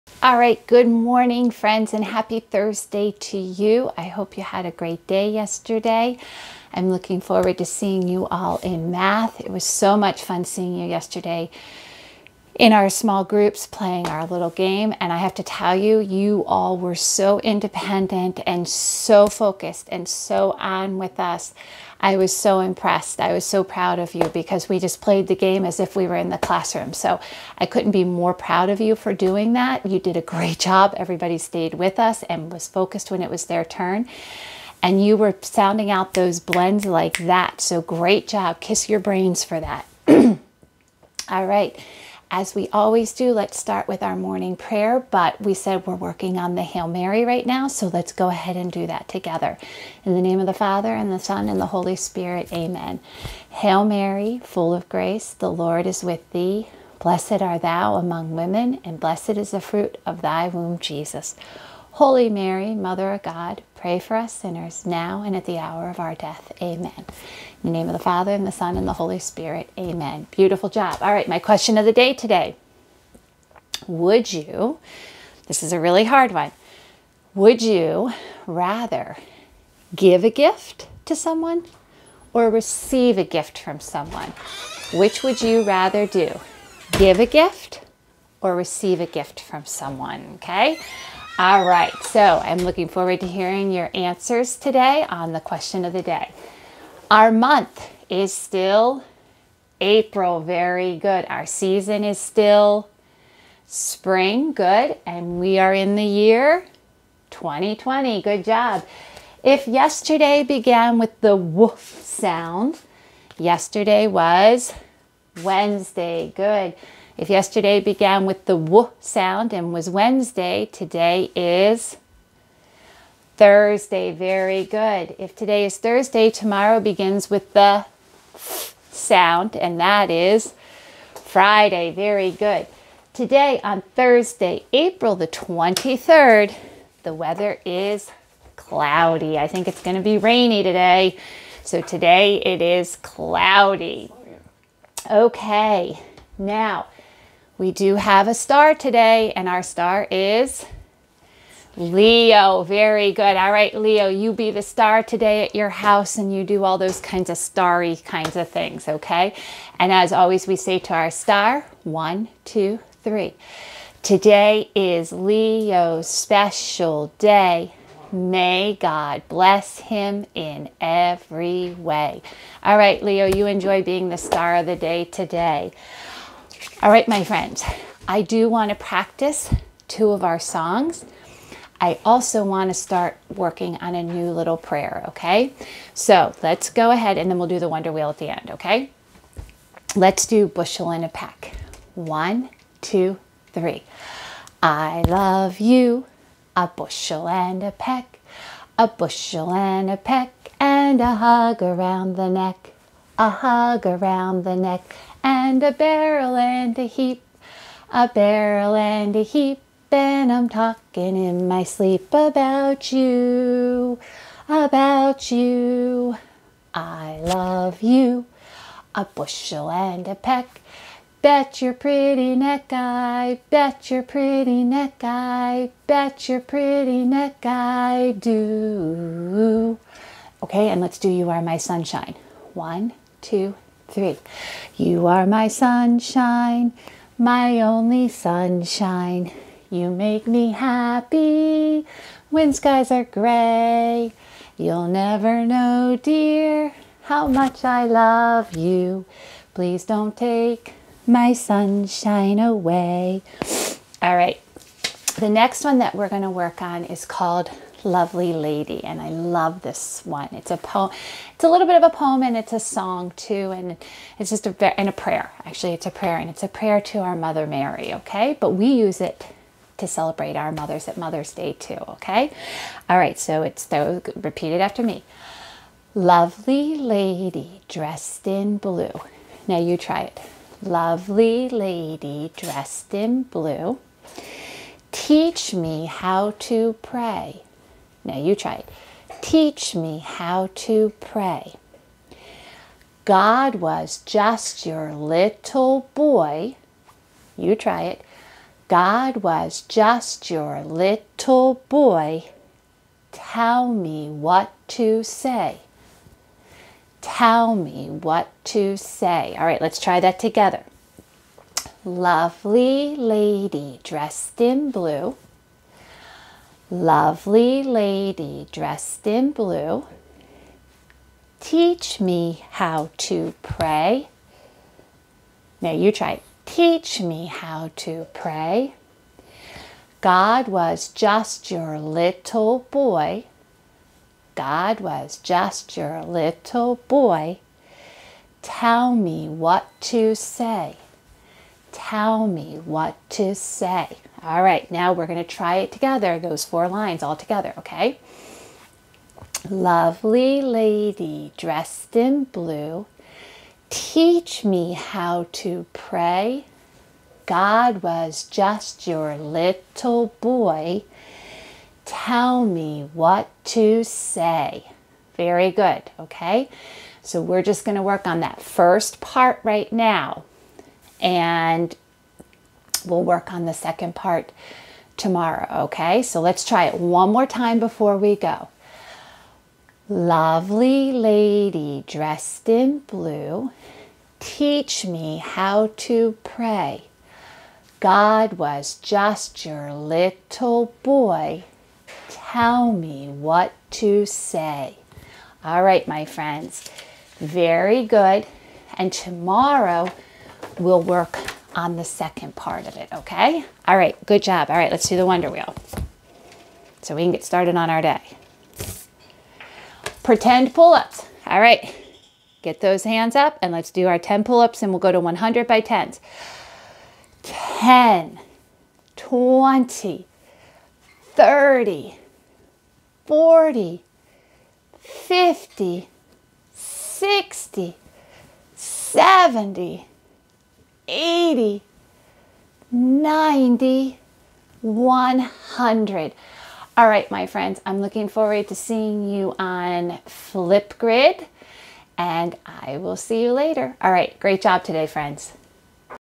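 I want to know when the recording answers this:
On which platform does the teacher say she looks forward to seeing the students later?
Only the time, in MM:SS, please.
07:20.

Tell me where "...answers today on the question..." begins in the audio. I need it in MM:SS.
01:33.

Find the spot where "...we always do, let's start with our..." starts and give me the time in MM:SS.
00:42.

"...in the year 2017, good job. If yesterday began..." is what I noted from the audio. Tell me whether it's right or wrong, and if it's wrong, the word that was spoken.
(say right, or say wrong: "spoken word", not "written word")
wrong: "2020", not "2017".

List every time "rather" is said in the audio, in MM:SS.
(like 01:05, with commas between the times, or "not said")
01:18, 01:25.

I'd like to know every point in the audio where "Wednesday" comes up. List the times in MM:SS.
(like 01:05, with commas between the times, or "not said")
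01:55, 01:59.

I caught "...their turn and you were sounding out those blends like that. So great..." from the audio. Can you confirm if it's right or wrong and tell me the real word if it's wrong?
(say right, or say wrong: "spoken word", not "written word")
right.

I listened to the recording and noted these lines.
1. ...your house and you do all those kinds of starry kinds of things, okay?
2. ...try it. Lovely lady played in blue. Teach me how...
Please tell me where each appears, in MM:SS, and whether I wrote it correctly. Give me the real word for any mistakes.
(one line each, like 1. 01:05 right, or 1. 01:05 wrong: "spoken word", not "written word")
1. 02:35 right
2. 04:39 wrong: "dressed", not "played".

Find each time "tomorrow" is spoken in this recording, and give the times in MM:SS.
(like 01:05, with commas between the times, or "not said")
02:06, 06:14, 06:38.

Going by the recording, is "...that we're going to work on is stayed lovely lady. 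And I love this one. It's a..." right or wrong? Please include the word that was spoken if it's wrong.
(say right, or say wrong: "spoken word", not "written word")
wrong: "called", not "stayed".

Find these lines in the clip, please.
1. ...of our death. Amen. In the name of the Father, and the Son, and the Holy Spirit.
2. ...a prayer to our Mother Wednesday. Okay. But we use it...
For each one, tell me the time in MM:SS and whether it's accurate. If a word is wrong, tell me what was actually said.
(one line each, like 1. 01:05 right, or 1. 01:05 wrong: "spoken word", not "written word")
1. 01:05 right
2. 04:26 wrong: "Mary", not "Wednesday".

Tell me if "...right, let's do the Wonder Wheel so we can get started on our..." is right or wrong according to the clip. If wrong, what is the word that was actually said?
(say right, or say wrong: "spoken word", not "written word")
right.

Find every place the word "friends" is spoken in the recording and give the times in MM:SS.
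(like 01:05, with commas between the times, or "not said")
00:01, 02:57, 06:36, 07:17, 07:24.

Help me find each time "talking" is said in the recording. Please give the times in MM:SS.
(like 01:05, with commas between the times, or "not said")
03:30.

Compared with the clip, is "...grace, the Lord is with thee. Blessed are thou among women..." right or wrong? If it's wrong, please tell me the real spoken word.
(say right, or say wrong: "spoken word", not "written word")
right.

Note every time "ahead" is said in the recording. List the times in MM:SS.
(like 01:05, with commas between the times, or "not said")
00:48, 03:06.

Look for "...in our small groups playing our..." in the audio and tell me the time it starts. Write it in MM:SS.
00:12.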